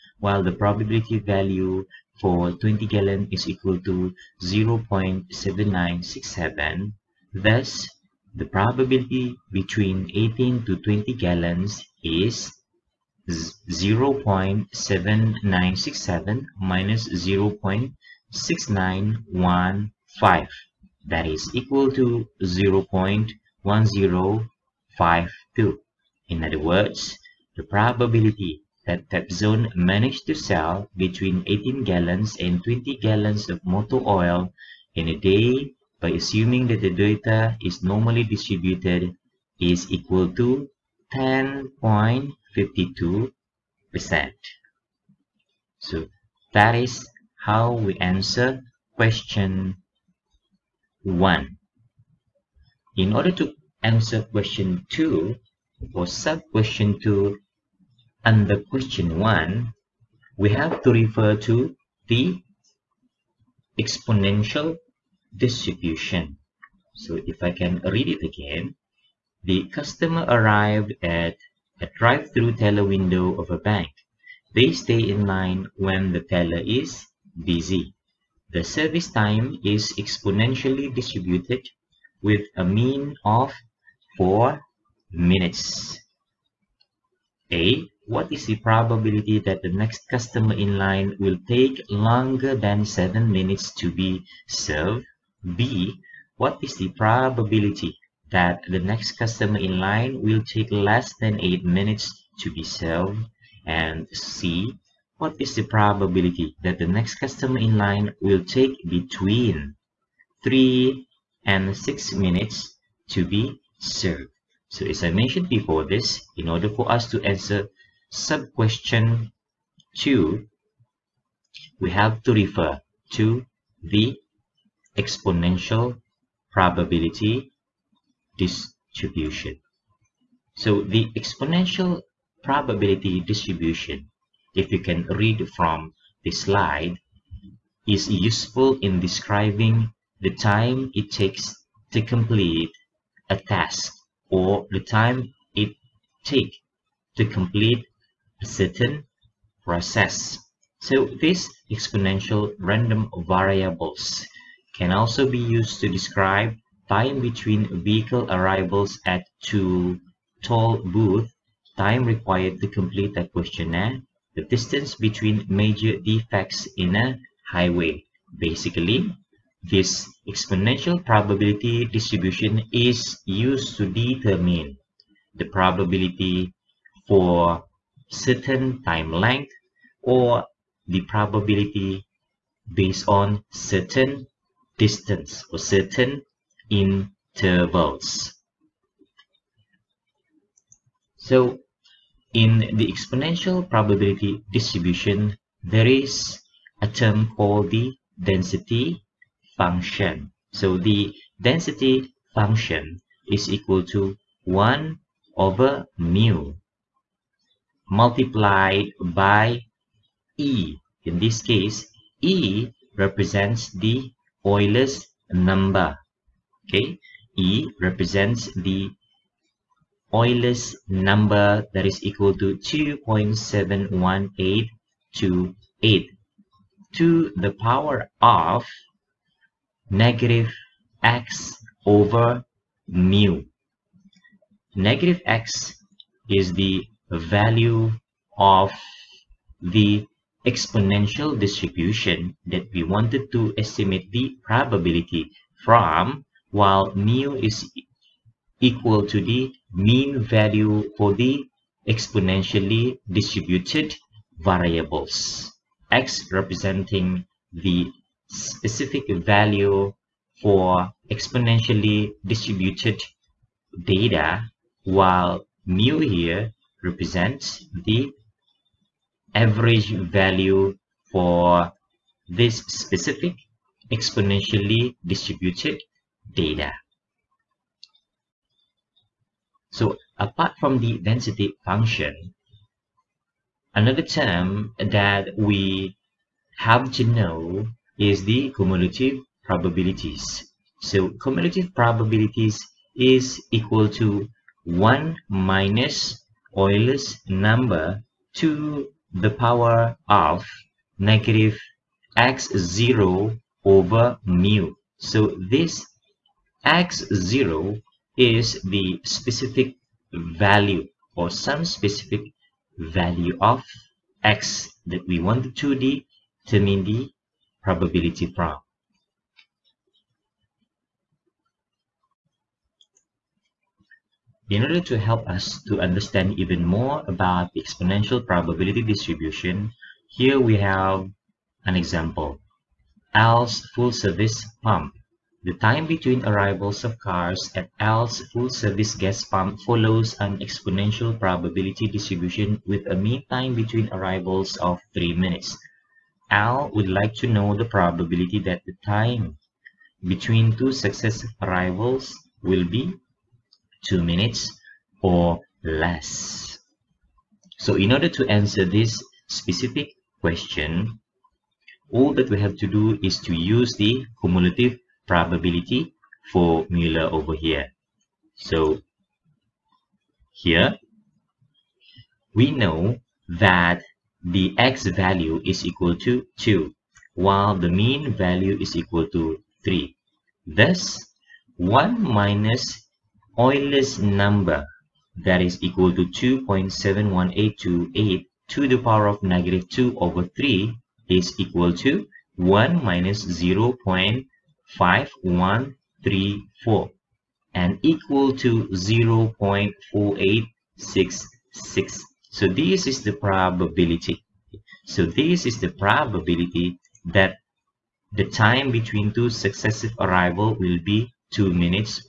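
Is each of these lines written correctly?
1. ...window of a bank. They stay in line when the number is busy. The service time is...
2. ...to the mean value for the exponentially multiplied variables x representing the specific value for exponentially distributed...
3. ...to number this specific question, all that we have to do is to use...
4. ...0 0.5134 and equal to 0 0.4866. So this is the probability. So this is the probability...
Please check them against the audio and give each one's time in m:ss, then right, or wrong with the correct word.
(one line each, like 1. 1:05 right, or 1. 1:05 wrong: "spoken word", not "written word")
1. 1:12 wrong: "teller", not "number"
2. 4:09 wrong: "distributed", not "multiplied"
3. 5:58 wrong: "answer", not "number"
4. 6:33 right.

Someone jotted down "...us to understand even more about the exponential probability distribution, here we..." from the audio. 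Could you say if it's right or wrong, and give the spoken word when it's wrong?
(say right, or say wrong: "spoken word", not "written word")
right.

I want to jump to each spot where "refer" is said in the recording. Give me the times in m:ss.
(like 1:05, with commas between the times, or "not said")
1:00, 2:02.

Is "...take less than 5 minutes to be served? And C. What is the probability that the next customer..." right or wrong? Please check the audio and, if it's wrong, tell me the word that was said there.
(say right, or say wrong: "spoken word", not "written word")
wrong: "8", not "5".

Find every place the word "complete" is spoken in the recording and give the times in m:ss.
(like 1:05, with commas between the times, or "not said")
2:22, 2:27, 2:42.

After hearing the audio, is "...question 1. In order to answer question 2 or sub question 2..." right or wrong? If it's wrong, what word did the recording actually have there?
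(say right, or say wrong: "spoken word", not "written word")
right.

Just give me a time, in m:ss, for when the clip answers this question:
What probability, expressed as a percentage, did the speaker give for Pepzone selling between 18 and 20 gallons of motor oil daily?
0:41.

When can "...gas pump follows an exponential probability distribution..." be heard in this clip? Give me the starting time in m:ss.
5:38.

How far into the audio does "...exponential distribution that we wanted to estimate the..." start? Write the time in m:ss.
4:00.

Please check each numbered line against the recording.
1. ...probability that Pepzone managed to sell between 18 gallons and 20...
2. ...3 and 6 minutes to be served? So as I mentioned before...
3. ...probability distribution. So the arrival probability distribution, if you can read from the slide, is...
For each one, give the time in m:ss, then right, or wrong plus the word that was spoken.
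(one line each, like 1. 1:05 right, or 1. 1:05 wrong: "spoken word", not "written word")
1. 0:27 right
2. 1:50 right
3. 2:06 wrong: "exponential", not "arrival".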